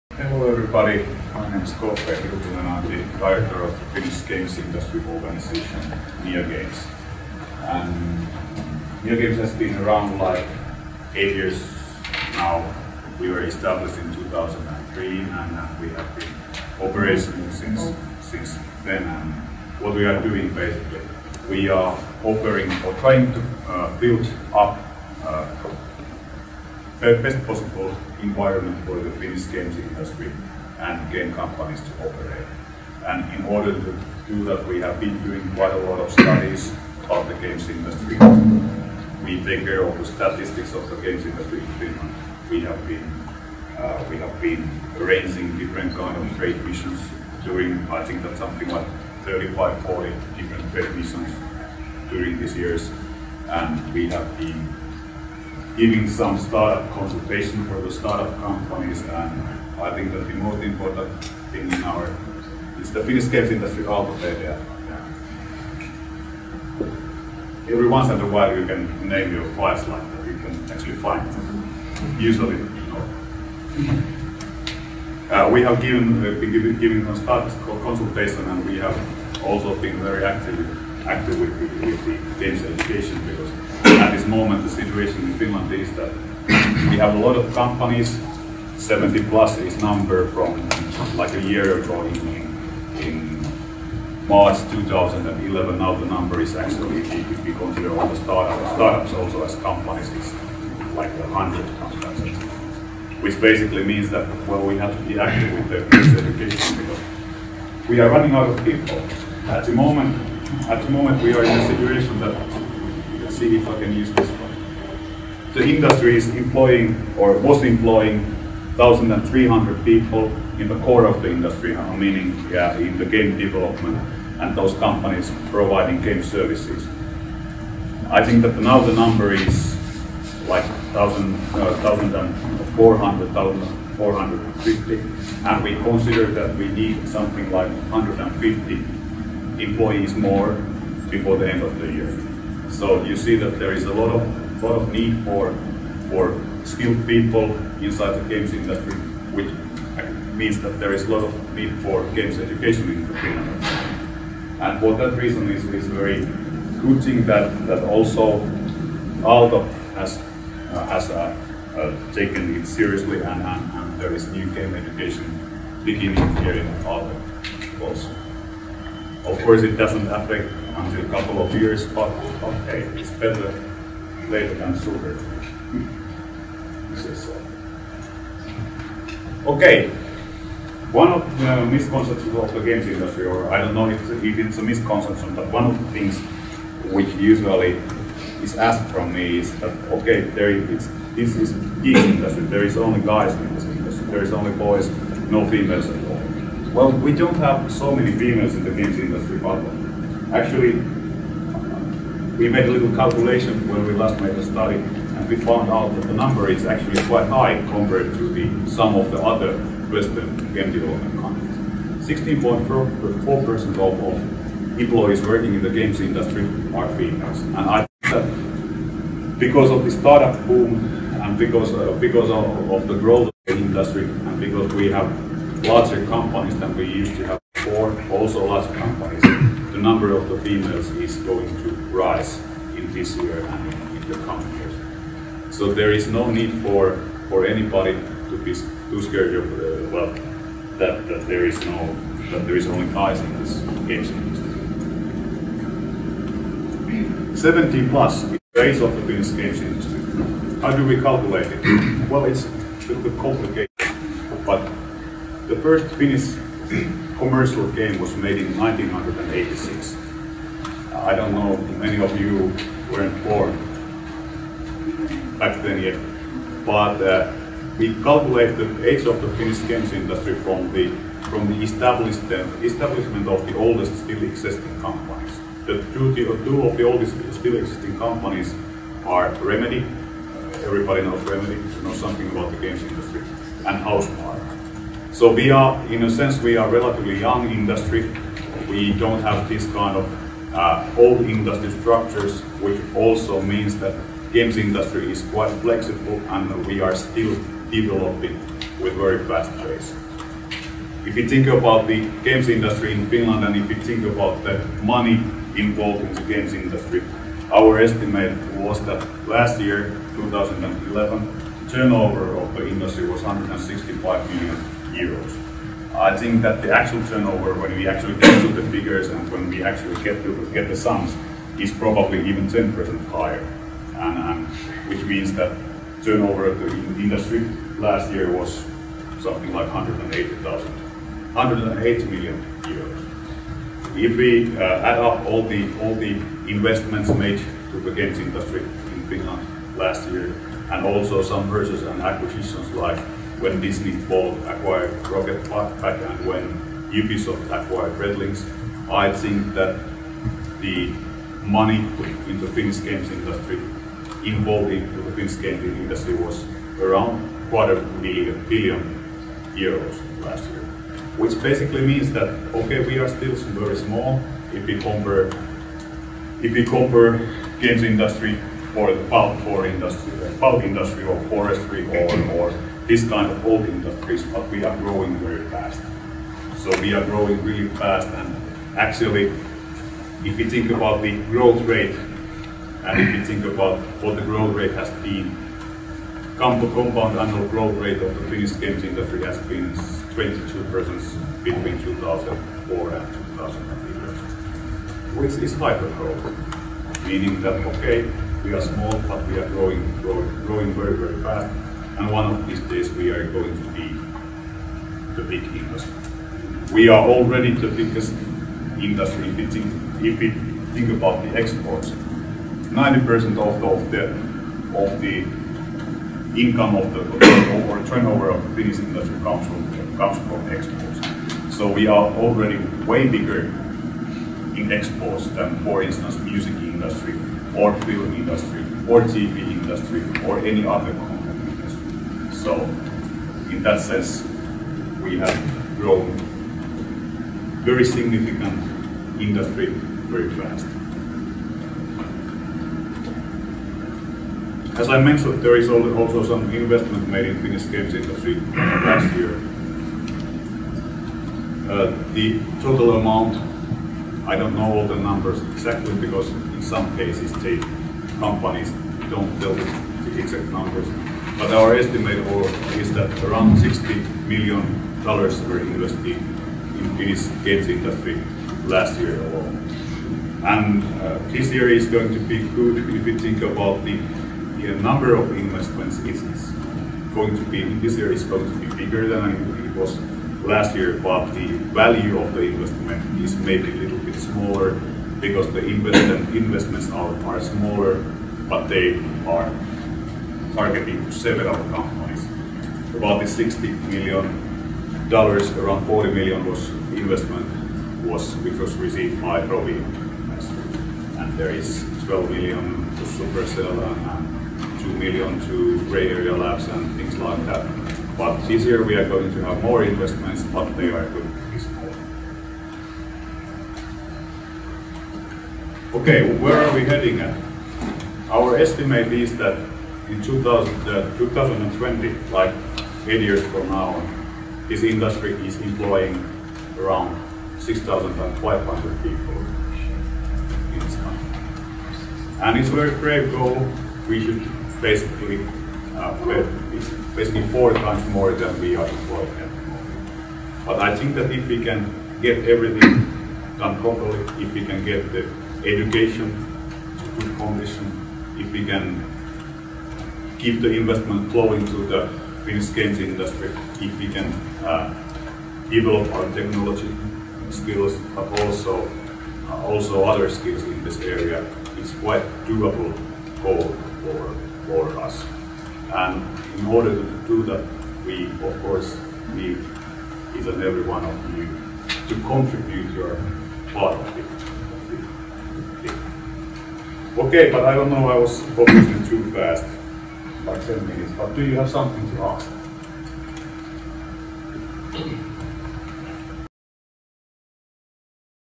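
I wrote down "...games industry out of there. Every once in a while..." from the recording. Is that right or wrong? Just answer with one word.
right.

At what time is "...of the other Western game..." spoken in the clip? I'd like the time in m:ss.
3:28.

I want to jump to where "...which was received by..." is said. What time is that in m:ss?
8:18.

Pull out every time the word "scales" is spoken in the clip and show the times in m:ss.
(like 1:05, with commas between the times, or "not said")
9:12.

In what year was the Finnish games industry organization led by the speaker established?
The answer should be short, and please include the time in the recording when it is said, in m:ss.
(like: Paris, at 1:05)
2003, at 0:14.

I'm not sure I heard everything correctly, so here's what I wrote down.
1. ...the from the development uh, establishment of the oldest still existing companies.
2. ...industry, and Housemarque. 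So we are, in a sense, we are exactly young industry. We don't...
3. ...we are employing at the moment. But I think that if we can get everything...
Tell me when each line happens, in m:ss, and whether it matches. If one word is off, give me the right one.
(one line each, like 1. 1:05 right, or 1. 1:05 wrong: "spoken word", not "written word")
1. 4:30 wrong: "establishment", not "development"
2. 4:42 wrong: "relatively", not "exactly"
3. 8:58 right.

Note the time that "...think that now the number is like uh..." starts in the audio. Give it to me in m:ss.
2:08.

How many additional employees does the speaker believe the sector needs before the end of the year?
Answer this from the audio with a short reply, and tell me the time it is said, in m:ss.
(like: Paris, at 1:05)
150, at 2:17.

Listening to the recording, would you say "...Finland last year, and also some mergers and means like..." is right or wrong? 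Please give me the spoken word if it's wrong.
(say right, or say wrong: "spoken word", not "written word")
wrong: "acquisitions", not "means".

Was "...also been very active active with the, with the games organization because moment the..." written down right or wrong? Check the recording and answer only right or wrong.
wrong.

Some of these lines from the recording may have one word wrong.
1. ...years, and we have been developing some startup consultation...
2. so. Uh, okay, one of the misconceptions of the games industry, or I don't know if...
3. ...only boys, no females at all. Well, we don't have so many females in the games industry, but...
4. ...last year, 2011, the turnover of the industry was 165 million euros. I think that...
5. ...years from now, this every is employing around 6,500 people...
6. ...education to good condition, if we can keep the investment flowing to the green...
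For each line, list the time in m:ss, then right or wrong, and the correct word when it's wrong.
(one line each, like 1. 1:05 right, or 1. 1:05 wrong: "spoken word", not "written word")
1. 0:52 wrong: "giving", not "developing"
2. 2:56 right
3. 3:14 right
4. 5:09 right
5. 8:43 wrong: "industry", not "every"
6. 9:05 right.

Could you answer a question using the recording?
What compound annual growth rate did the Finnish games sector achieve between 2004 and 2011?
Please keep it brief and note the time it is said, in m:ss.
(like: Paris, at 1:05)
22%, at 6:30.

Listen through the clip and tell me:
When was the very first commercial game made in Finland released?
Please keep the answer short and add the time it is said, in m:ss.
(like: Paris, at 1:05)
1986, at 4:18.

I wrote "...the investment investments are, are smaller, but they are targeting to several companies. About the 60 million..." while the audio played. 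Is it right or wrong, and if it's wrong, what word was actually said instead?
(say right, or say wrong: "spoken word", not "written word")
right.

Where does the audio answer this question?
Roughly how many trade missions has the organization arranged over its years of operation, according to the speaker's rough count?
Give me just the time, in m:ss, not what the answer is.
0:49.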